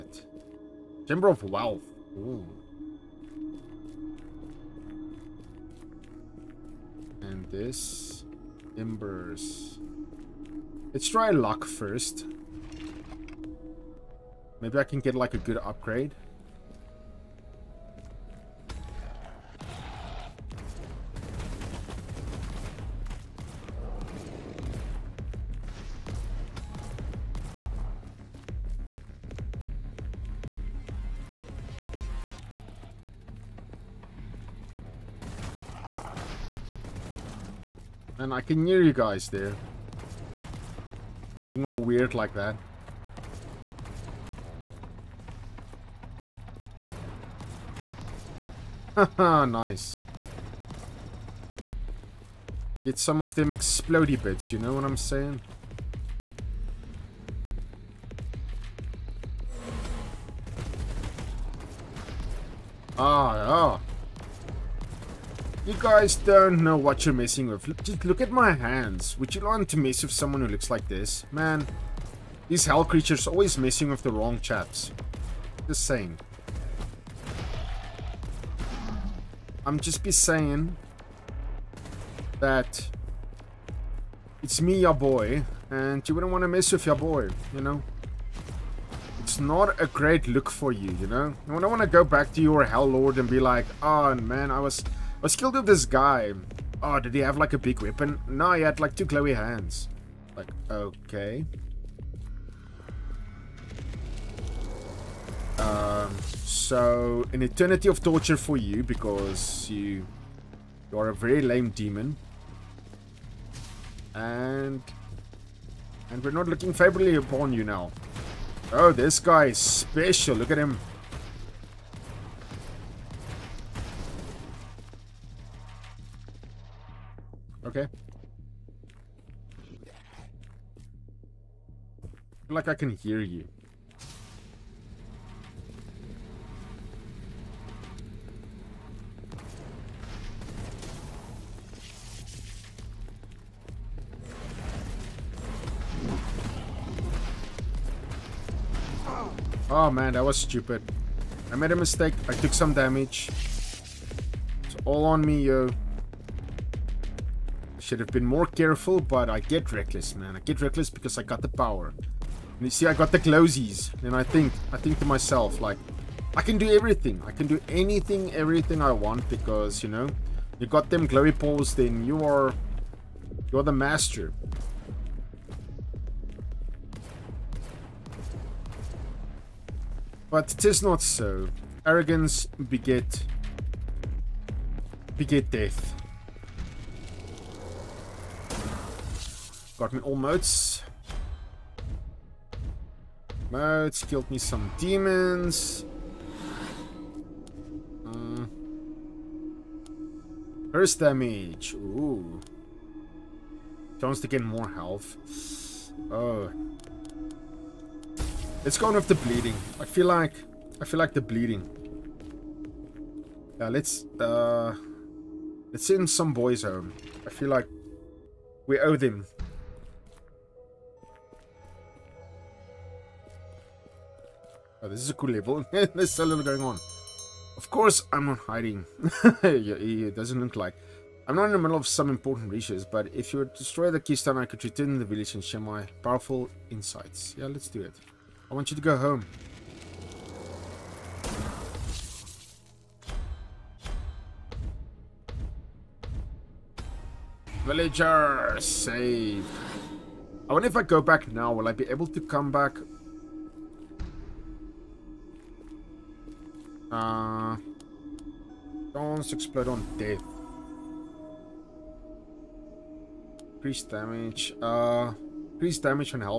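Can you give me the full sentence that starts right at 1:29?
It's not a great look for you, you know?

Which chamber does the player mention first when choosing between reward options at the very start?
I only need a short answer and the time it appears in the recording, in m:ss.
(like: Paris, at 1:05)
Chamber of Wealth, at 0:01.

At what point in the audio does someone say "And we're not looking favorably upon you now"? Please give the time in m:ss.
1:56.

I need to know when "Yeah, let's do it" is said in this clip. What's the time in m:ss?
3:57.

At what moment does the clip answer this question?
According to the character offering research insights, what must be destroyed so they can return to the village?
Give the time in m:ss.
3:53.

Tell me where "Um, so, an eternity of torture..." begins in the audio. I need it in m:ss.
1:45.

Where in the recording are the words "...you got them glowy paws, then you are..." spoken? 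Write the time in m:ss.
2:50.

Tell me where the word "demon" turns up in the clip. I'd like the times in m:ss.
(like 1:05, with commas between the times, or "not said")
1:51, 3:14.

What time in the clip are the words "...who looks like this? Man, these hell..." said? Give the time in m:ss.
1:10.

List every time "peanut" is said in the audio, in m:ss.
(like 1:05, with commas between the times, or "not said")
not said.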